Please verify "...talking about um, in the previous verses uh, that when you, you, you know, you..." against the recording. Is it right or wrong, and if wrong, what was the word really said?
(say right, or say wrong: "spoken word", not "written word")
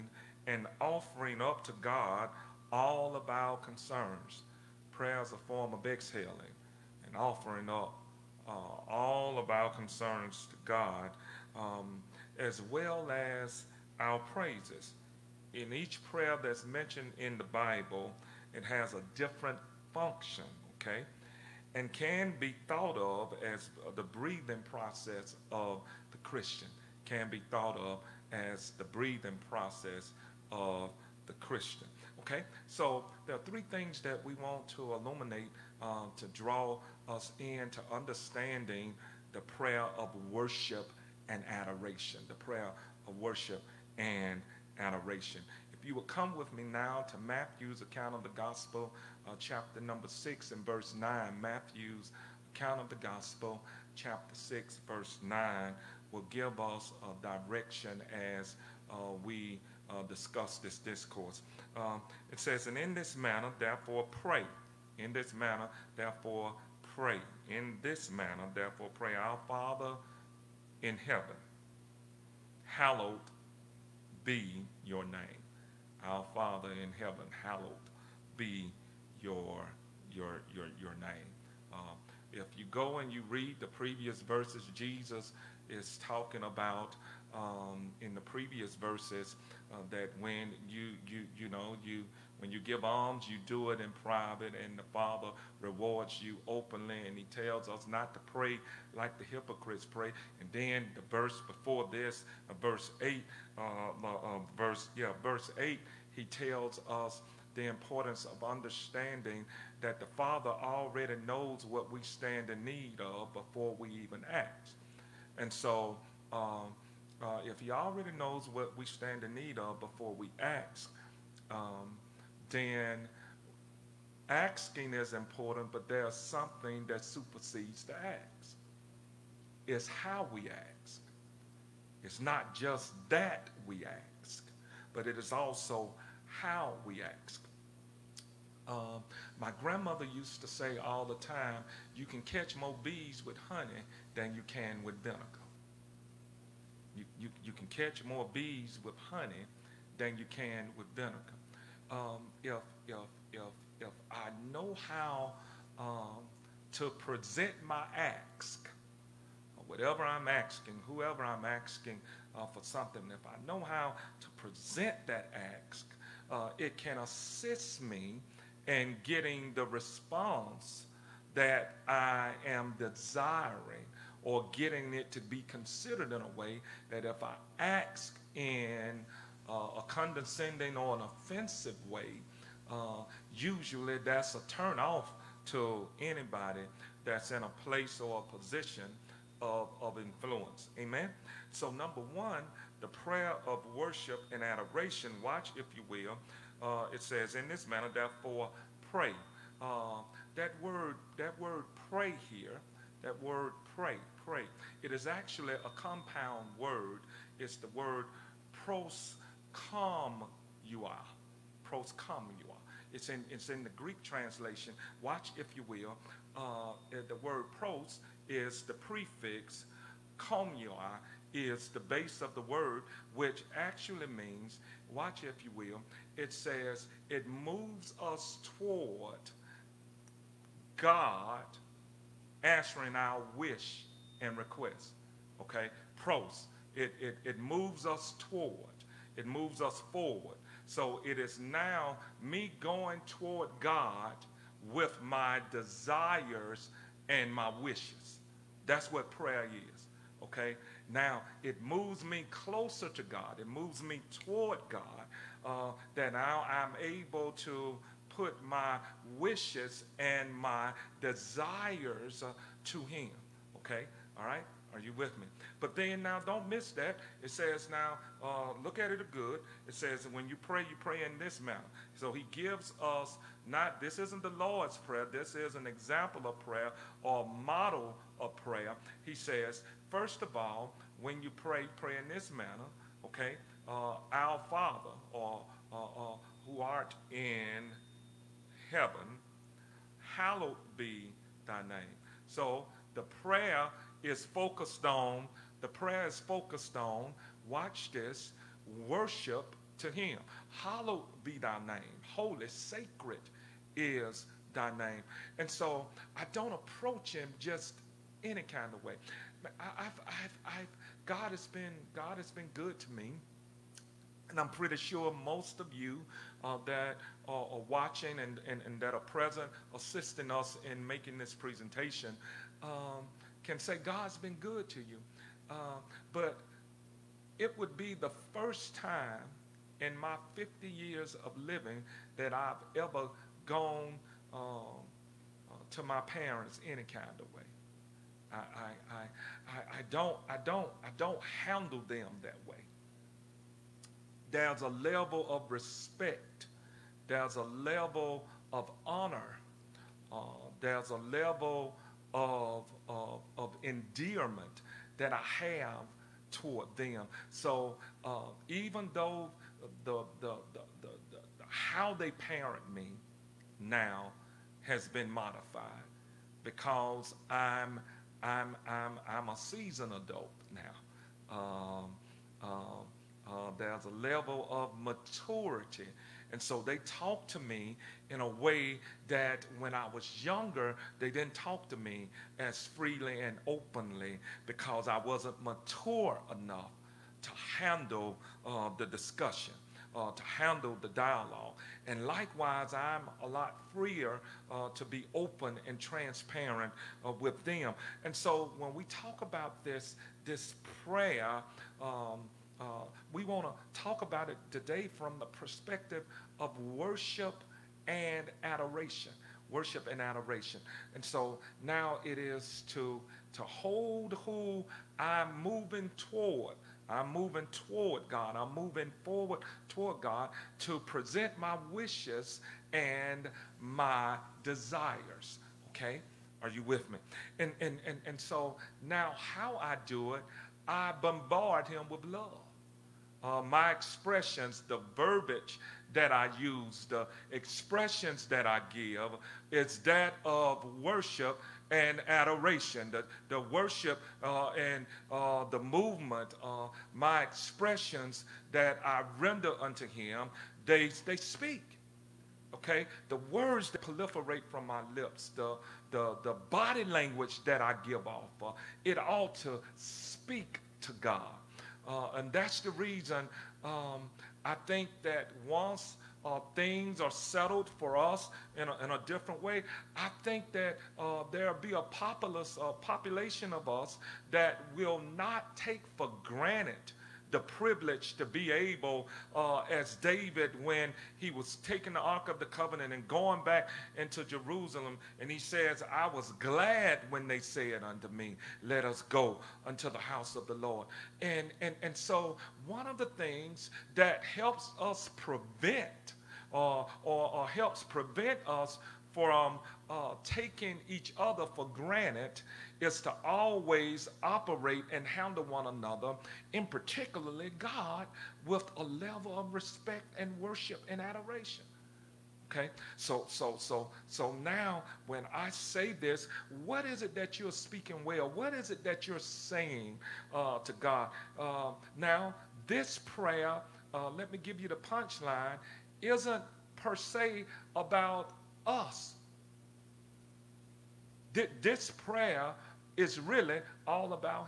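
right.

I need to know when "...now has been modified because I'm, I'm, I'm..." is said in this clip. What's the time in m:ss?
6:03.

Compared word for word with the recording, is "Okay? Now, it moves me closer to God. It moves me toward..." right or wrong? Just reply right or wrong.
right.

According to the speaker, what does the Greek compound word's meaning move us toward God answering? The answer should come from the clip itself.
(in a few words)
Our wish and request.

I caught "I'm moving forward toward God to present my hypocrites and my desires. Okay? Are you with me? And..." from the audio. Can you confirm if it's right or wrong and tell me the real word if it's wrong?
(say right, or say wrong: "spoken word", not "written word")
wrong: "wishes", not "hypocrites".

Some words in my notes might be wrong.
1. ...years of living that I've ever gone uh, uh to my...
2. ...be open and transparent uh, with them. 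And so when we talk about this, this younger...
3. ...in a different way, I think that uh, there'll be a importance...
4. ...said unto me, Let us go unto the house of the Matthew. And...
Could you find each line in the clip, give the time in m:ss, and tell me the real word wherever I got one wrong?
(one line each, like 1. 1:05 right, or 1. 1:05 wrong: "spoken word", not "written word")
1. 5:30 right
2. 6:34 wrong: "prayer", not "younger"
3. 7:48 wrong: "populace", not "importance"
4. 8:07 wrong: "Lord", not "Matthew".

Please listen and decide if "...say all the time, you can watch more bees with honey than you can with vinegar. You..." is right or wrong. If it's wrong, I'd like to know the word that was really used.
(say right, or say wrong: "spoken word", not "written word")
wrong: "catch", not "watch".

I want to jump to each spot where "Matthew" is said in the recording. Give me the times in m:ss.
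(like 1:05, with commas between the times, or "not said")
0:47, 0:51.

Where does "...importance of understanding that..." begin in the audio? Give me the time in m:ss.
1:47.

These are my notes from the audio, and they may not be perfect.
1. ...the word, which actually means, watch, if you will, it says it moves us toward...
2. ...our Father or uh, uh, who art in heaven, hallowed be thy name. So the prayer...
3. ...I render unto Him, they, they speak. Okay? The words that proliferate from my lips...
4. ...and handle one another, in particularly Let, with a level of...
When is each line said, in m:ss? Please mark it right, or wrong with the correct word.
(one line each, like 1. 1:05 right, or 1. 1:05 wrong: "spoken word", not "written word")
1. 3:42 right
2. 4:44 right
3. 7:28 right
4. 8:24 wrong: "God", not "Let".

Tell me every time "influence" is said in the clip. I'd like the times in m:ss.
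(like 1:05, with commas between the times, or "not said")
3:09.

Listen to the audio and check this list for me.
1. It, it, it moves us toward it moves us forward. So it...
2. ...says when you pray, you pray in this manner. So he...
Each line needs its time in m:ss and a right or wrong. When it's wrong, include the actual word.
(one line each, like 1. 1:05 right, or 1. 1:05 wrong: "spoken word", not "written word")
1. 3:56 right
2. 4:29 right.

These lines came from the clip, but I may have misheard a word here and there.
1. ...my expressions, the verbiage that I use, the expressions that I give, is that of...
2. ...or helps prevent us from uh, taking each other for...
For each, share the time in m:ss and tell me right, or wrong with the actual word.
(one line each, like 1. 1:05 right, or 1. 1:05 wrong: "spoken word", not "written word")
1. 7:13 right
2. 8:17 right.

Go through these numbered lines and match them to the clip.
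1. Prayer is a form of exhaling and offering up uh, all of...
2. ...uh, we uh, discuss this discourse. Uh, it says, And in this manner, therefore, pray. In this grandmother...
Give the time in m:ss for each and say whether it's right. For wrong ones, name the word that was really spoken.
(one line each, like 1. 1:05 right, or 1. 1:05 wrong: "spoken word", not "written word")
1. 0:04 right
2. 0:58 wrong: "manner", not "grandmother".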